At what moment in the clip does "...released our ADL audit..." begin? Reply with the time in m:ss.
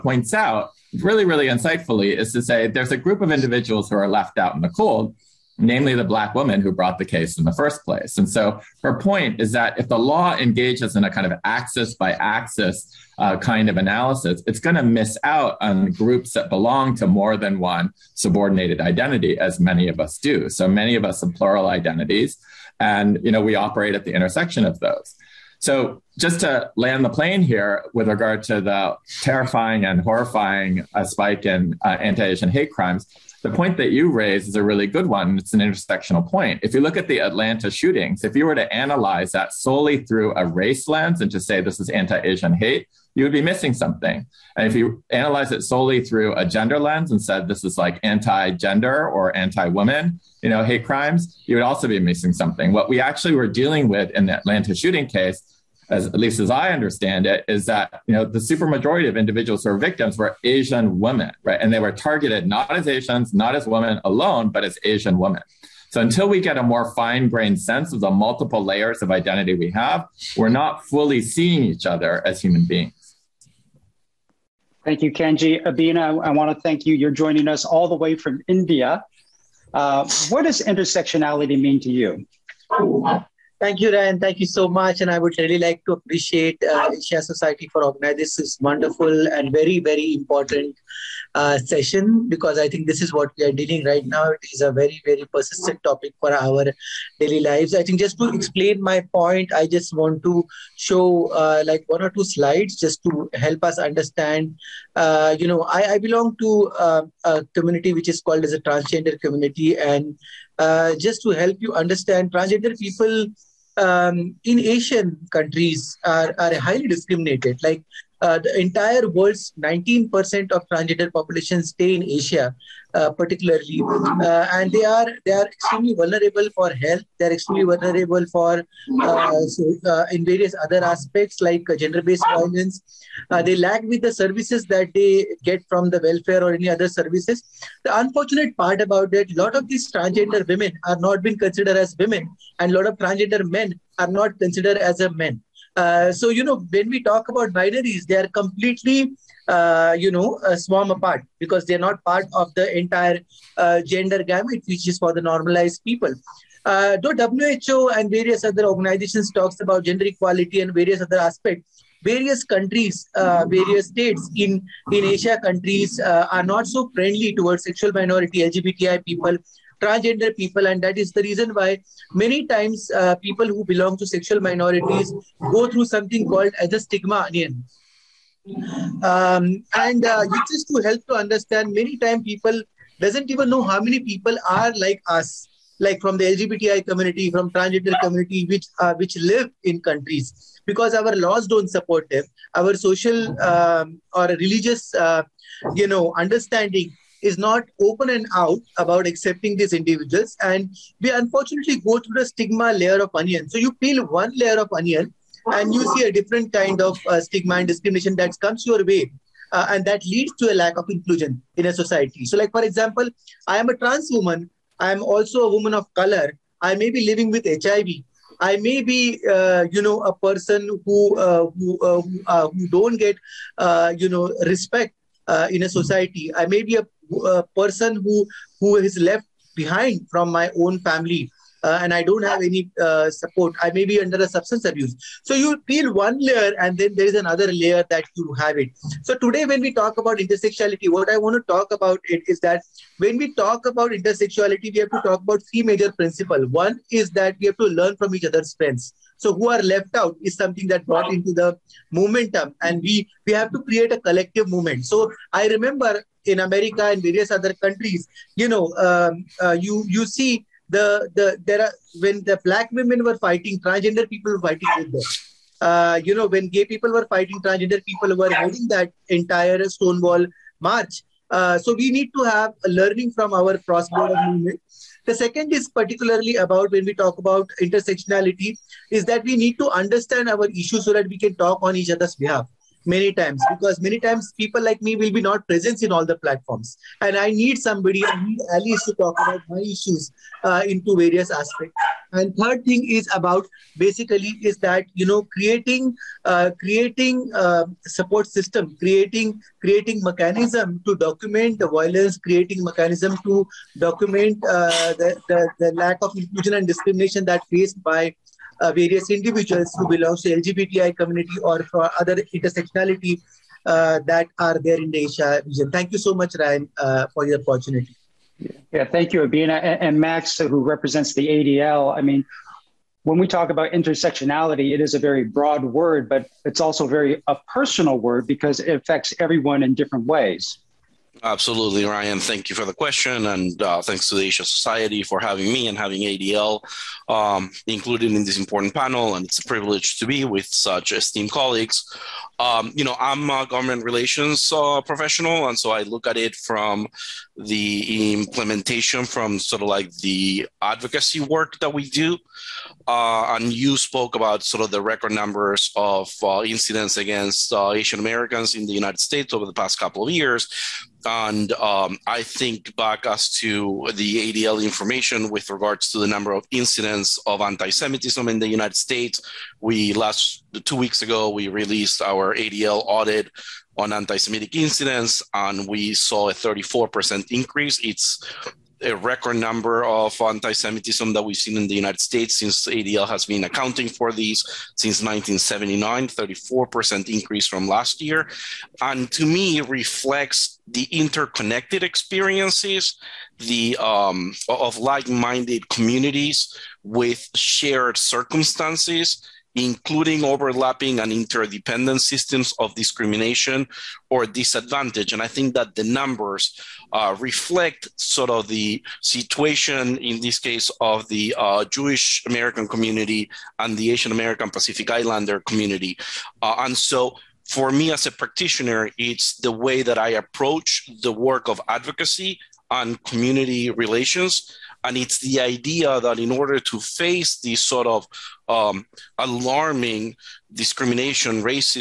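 6:11.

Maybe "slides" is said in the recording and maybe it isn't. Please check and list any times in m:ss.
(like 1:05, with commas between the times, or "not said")
1:42.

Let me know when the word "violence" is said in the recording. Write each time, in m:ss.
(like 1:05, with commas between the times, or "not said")
2:12, 5:01.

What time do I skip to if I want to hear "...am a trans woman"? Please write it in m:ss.
3:33.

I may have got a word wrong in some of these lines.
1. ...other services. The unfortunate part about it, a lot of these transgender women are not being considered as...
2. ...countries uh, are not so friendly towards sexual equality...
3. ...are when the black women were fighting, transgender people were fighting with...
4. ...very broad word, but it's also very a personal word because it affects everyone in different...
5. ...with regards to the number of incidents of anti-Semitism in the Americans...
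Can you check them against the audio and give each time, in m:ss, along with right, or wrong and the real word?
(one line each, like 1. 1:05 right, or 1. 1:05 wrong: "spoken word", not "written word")
1. 2:16 right
2. 2:45 wrong: "minority", not "equality"
3. 4:21 right
4. 5:24 right
5. 6:05 wrong: "United", not "Americans".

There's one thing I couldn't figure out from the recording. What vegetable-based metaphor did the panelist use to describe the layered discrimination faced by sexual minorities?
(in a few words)
stigma onion.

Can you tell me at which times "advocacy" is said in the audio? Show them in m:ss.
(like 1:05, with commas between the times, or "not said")
5:50, 7:01.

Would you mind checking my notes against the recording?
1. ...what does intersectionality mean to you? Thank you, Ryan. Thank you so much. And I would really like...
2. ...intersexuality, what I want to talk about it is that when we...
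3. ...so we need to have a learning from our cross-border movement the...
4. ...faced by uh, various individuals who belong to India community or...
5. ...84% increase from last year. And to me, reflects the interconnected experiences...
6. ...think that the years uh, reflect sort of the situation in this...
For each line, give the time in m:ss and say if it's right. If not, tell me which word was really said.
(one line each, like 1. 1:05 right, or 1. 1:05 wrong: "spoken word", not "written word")
1. 1:20 right
2. 4:00 right
3. 4:31 right
4. 5:07 wrong: "LGBTI", not "India"
5. 6:26 wrong: "34", not "84"
6. 6:45 wrong: "numbers", not "years".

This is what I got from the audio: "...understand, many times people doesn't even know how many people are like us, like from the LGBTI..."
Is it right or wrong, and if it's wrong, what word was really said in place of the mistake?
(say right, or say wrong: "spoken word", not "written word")
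right.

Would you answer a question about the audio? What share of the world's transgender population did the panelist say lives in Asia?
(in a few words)
19%.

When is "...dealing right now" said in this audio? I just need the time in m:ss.
1:33.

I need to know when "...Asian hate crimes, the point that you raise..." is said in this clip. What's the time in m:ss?
0:32.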